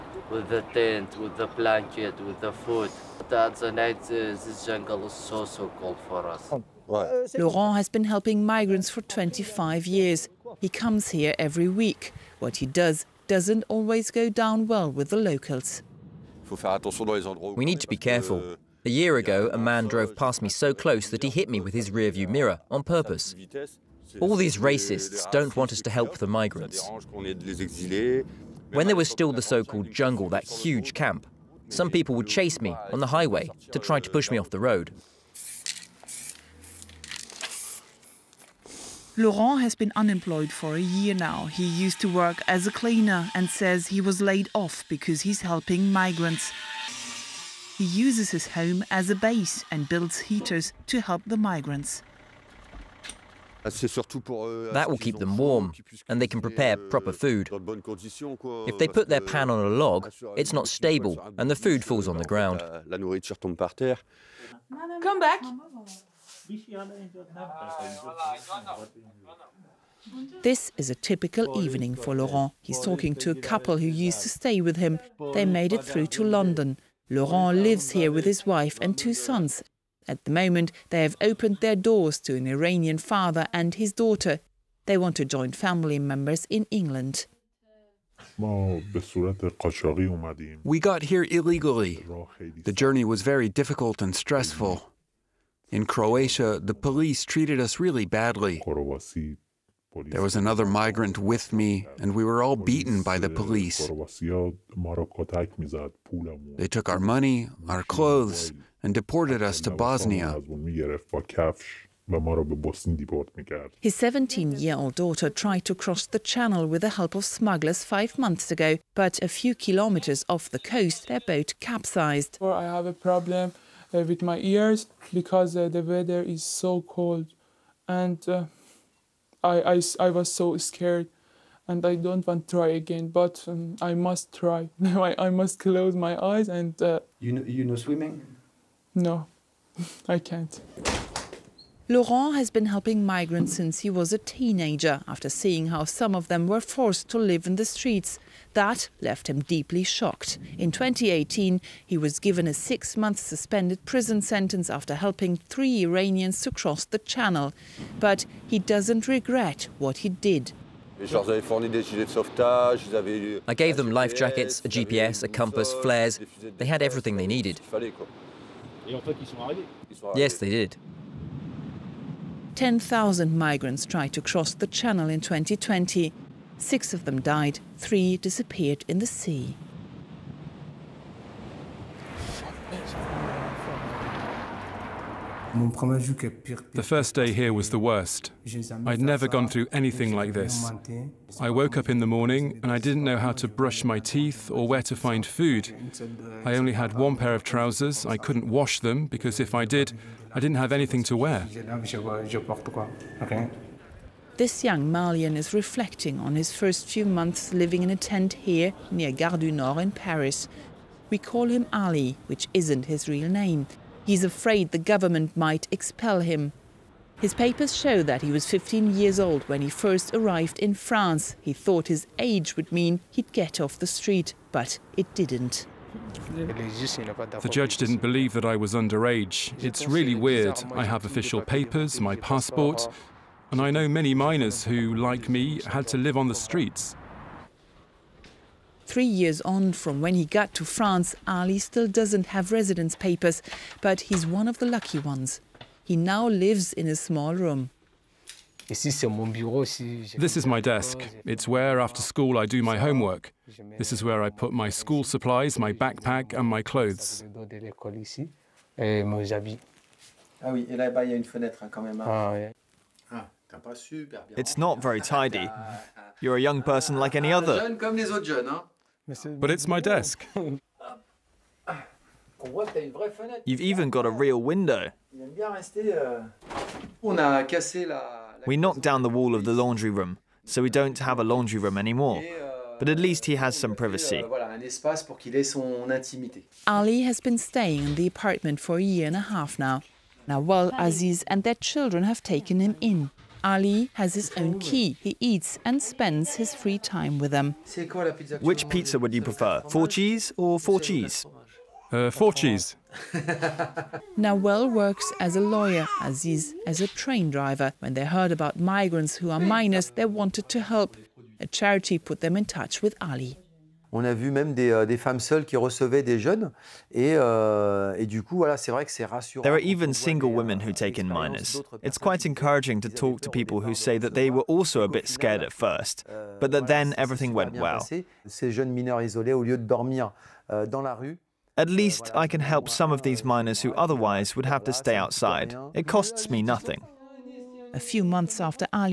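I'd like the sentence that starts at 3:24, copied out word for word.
This young Malian is reflecting on his first few months living in a tent here near Gare du Nord in Paris.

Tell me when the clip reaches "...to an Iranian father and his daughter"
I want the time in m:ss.
1:22.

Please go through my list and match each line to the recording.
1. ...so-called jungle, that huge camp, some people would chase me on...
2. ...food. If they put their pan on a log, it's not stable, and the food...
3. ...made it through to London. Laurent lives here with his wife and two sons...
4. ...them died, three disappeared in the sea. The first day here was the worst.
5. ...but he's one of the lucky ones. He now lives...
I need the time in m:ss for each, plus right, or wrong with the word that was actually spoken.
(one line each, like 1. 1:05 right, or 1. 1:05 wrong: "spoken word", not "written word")
1. 0:29 right
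2. 0:57 right
3. 1:15 right
4. 2:57 right
5. 4:03 right.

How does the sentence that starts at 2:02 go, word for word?
I have a problem uh, with my ears because uh, the weather is so cold and.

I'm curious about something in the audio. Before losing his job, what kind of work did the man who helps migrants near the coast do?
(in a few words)
Cleaner.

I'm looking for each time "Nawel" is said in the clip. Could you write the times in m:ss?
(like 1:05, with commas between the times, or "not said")
4:50, 5:04.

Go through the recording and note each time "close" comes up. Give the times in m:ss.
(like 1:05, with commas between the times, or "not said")
0:20, 2:15.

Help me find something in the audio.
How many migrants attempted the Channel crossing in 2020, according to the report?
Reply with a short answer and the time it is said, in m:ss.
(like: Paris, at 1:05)
10,000, at 2:52.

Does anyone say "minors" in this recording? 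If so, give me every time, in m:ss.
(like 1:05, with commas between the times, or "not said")
3:54, 5:09, 5:21, 5:33.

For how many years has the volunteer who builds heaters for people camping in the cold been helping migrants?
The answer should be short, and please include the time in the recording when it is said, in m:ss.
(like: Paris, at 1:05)
25, at 0:09.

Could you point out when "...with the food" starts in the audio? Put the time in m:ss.
0:02.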